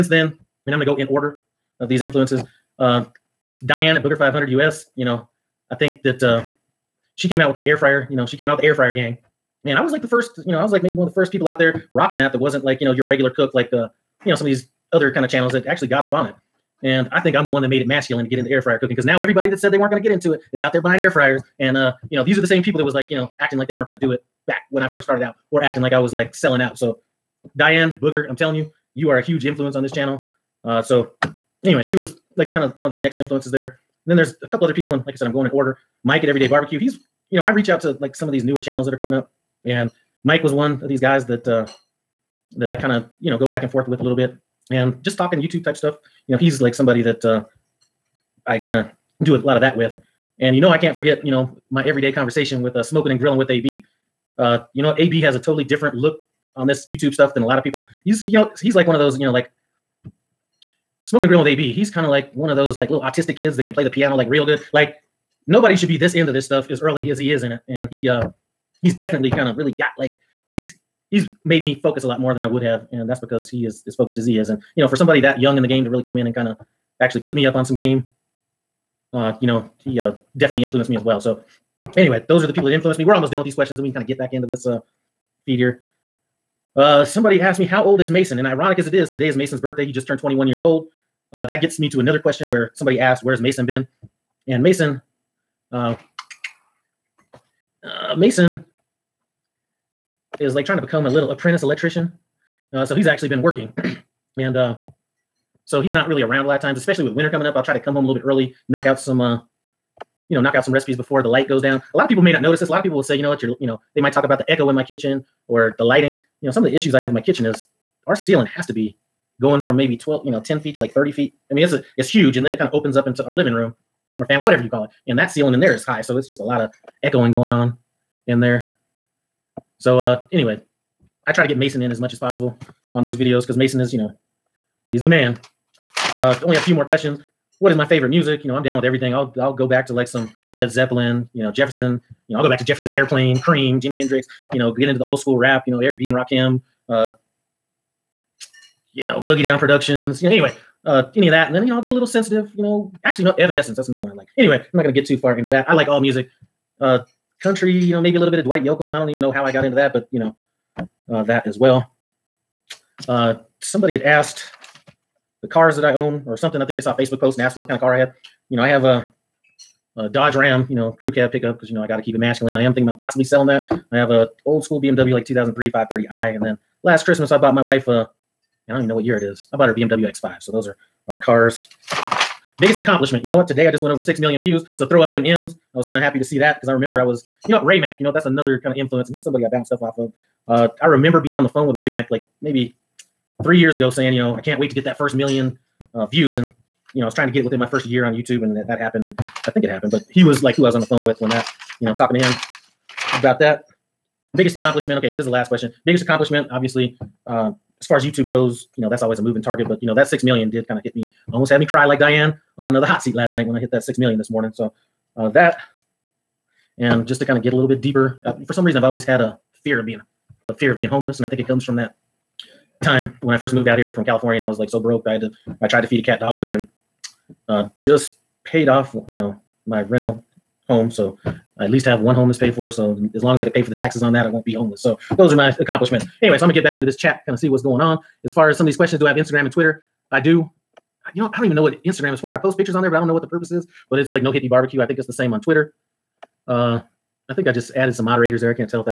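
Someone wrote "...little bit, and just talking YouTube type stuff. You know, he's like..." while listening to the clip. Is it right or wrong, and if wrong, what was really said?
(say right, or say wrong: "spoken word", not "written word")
right.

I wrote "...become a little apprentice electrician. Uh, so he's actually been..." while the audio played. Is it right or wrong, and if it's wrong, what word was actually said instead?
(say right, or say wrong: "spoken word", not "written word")
right.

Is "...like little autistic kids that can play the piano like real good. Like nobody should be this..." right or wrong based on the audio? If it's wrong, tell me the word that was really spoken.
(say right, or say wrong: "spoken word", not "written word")
right.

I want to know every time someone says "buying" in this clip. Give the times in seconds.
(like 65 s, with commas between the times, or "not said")
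20 s.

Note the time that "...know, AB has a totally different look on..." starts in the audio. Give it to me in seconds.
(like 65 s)
54 s.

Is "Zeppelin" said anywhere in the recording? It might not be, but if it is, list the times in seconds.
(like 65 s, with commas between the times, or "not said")
140 s.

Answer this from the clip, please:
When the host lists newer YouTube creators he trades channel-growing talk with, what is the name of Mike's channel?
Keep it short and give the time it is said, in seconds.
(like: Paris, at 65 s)
Everyday Barbecue, at 36 s.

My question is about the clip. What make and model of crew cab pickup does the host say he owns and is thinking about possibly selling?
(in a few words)
Dodge Ram.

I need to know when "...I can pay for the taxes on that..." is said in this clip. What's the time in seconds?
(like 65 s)
233 s.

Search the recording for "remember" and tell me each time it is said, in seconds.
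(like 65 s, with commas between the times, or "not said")
186 s, 190 s.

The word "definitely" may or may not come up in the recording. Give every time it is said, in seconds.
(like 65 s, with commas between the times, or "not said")
68 s, 80 s.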